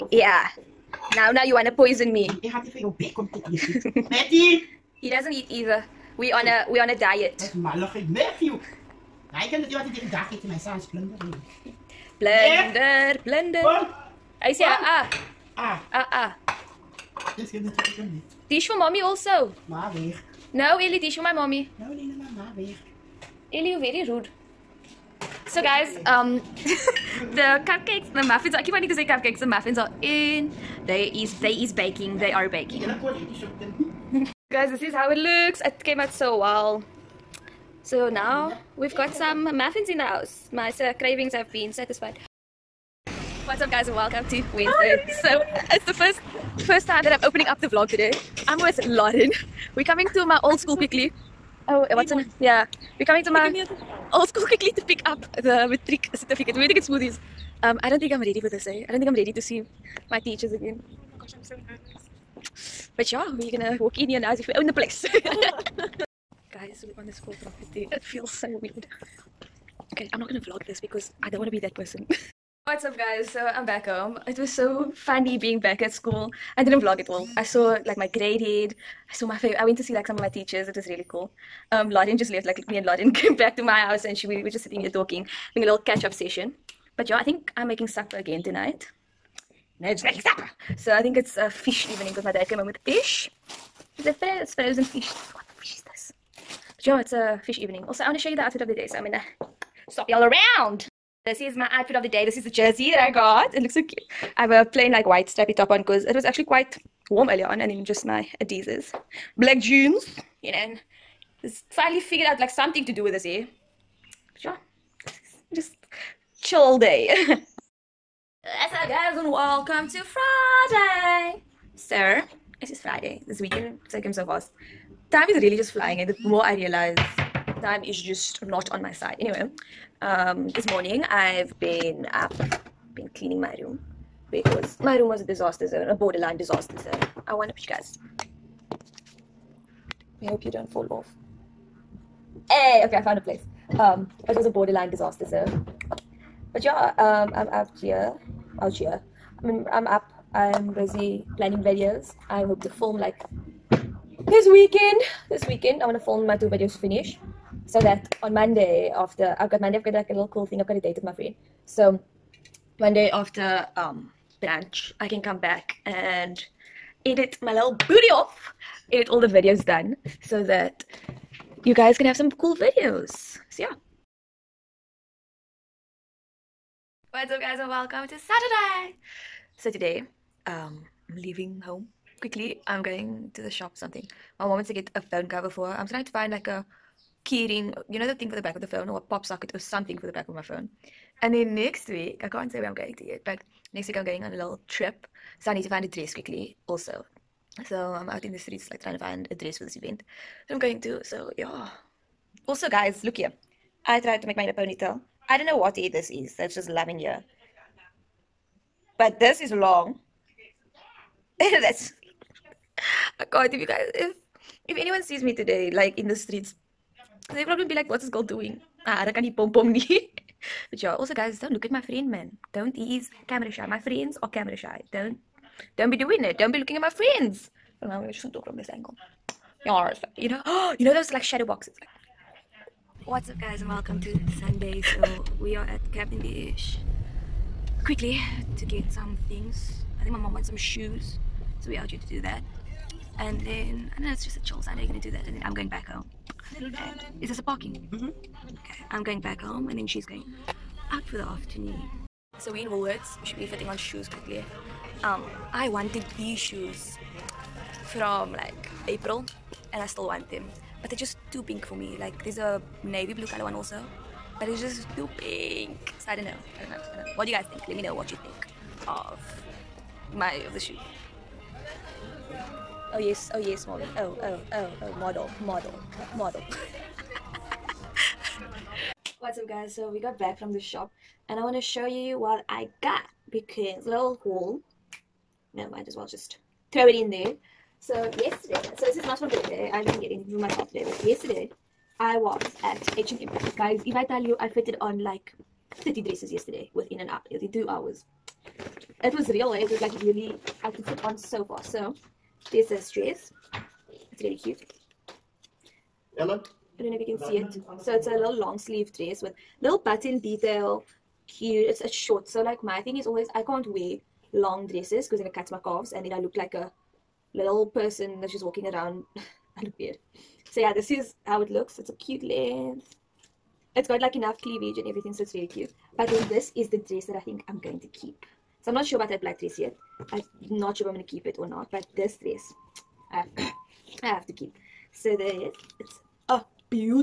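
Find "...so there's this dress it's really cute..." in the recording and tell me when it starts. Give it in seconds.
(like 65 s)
301 s.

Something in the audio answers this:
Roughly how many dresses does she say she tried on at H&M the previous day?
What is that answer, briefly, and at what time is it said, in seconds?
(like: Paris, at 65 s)
30, at 295 s.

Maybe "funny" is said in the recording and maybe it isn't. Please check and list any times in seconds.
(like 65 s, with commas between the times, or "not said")
74 s.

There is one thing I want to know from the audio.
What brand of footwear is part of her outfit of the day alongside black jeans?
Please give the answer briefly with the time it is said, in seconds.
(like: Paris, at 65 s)
Adidas, at 108 s.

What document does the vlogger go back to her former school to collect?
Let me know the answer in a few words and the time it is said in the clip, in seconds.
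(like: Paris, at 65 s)
Matric certificate, at 55 s.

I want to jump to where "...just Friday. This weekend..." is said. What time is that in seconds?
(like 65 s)
122 s.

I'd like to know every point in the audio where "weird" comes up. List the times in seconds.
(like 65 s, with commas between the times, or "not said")
68 s, 319 s.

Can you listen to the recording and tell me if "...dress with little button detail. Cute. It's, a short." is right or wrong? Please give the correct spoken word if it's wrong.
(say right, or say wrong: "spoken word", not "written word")
right.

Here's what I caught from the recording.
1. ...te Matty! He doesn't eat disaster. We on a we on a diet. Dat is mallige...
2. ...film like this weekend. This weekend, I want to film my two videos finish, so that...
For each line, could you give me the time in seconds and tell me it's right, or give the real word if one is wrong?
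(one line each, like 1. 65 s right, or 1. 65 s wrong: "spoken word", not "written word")
1. 3 s wrong: "either", not "disaster"
2. 152 s right.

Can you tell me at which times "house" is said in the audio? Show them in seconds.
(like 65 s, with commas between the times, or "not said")
40 s, 83 s.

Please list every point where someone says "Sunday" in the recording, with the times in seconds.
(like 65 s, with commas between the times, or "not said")
234 s, 244 s.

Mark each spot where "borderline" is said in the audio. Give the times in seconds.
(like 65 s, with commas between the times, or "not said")
135 s, 144 s.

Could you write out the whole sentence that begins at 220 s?
But yeah, also guys, don't look at my friend, man.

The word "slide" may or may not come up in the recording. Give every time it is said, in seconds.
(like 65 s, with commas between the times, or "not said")
not said.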